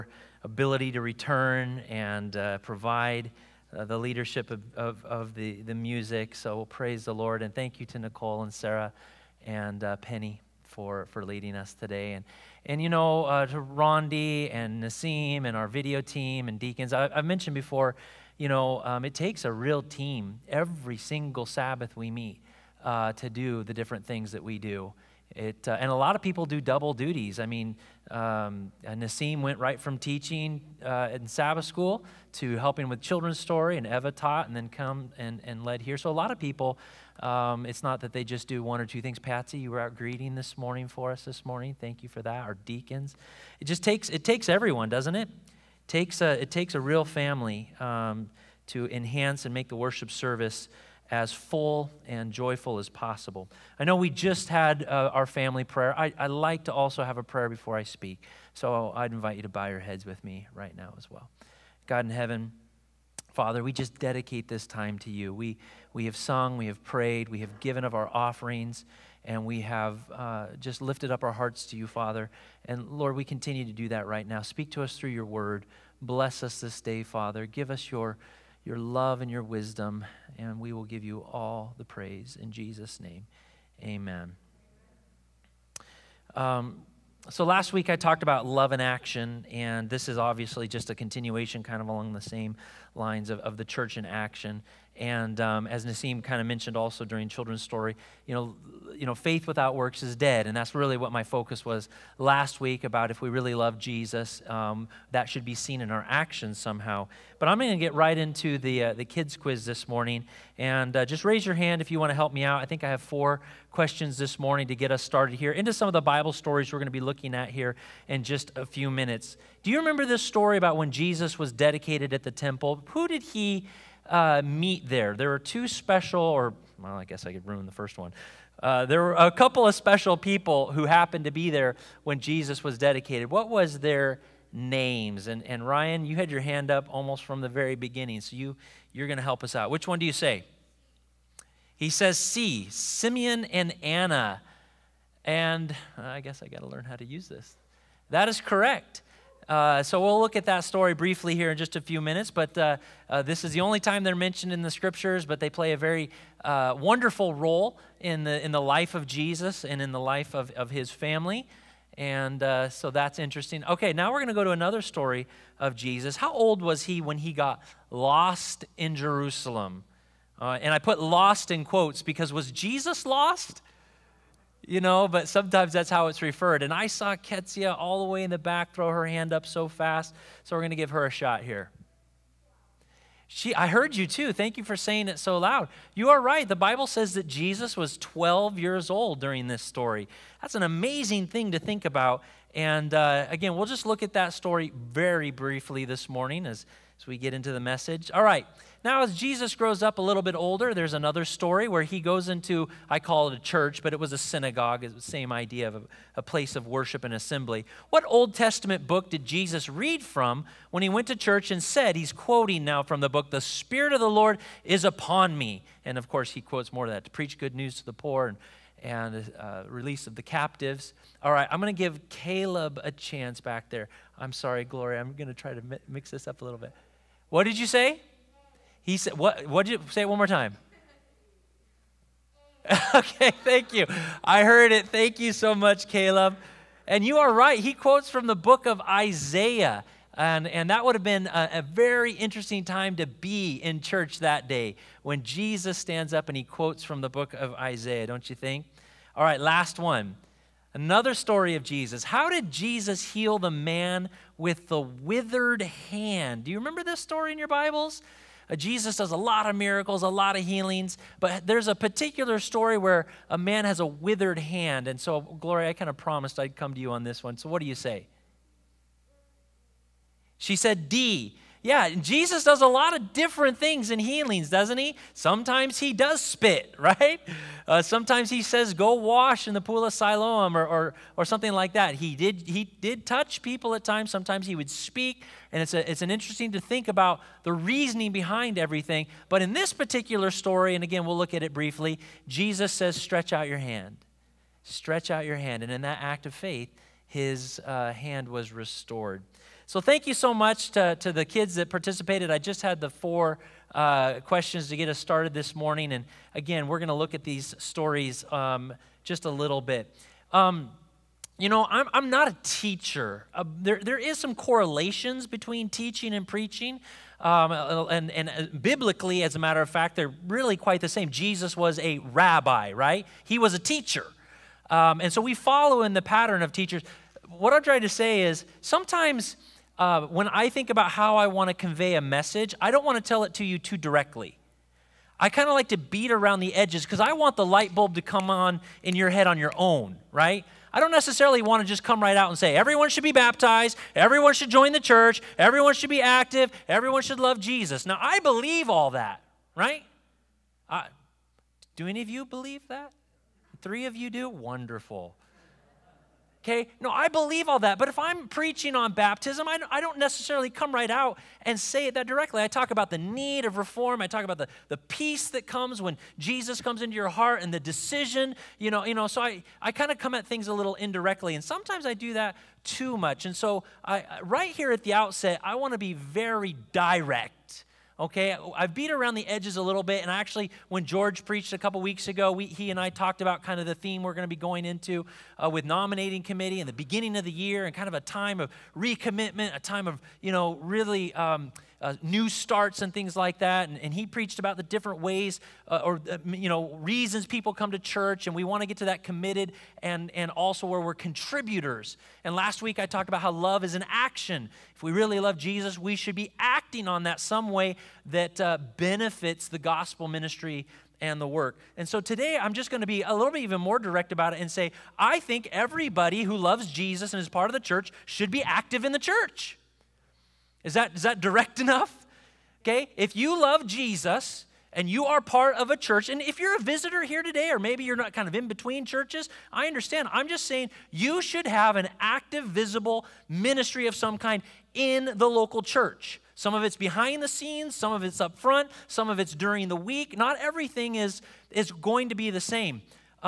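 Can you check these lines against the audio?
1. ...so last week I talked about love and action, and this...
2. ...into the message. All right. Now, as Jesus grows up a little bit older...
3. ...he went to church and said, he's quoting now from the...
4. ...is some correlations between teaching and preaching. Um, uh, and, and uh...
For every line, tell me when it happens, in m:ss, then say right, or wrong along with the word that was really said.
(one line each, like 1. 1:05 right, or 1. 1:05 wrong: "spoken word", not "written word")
1. 1:27 right
2. 3:17 right
3. 3:30 right
4. 5:13 right.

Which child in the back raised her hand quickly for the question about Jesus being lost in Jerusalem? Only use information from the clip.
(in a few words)
Ketsia.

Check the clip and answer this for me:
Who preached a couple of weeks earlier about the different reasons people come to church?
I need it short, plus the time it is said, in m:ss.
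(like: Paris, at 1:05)
George, at 6:20.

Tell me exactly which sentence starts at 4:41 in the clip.
He did, he did touch people at times.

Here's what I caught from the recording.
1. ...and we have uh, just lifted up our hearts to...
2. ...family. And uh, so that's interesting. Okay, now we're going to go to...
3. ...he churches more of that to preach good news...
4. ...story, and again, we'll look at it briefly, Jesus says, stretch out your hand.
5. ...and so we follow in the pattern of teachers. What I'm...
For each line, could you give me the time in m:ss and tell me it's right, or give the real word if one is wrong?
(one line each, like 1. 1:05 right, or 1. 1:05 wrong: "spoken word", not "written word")
1. 1:09 right
2. 2:40 right
3. 3:36 wrong: "quotes", not "churches"
4. 4:50 right
5. 5:24 right.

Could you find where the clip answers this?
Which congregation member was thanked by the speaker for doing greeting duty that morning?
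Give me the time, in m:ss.
0:39.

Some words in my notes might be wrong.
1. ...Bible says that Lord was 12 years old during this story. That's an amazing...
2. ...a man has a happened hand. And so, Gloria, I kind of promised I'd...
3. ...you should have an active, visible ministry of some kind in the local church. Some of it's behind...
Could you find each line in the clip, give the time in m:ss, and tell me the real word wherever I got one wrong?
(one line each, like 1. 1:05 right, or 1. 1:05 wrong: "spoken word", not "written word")
1. 3:06 wrong: "Jesus", not "Lord"
2. 4:23 wrong: "withered", not "happened"
3. 7:10 right.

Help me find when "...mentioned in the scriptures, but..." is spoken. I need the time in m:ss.
2:34.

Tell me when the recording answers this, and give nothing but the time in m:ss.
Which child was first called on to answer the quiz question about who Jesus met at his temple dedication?
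2:15.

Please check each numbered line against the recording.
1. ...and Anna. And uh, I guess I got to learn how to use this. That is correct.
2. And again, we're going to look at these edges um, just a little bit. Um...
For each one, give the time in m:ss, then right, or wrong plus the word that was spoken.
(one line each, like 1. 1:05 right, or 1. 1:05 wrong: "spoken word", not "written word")
1. 2:23 right
2. 5:05 wrong: "stories", not "edges".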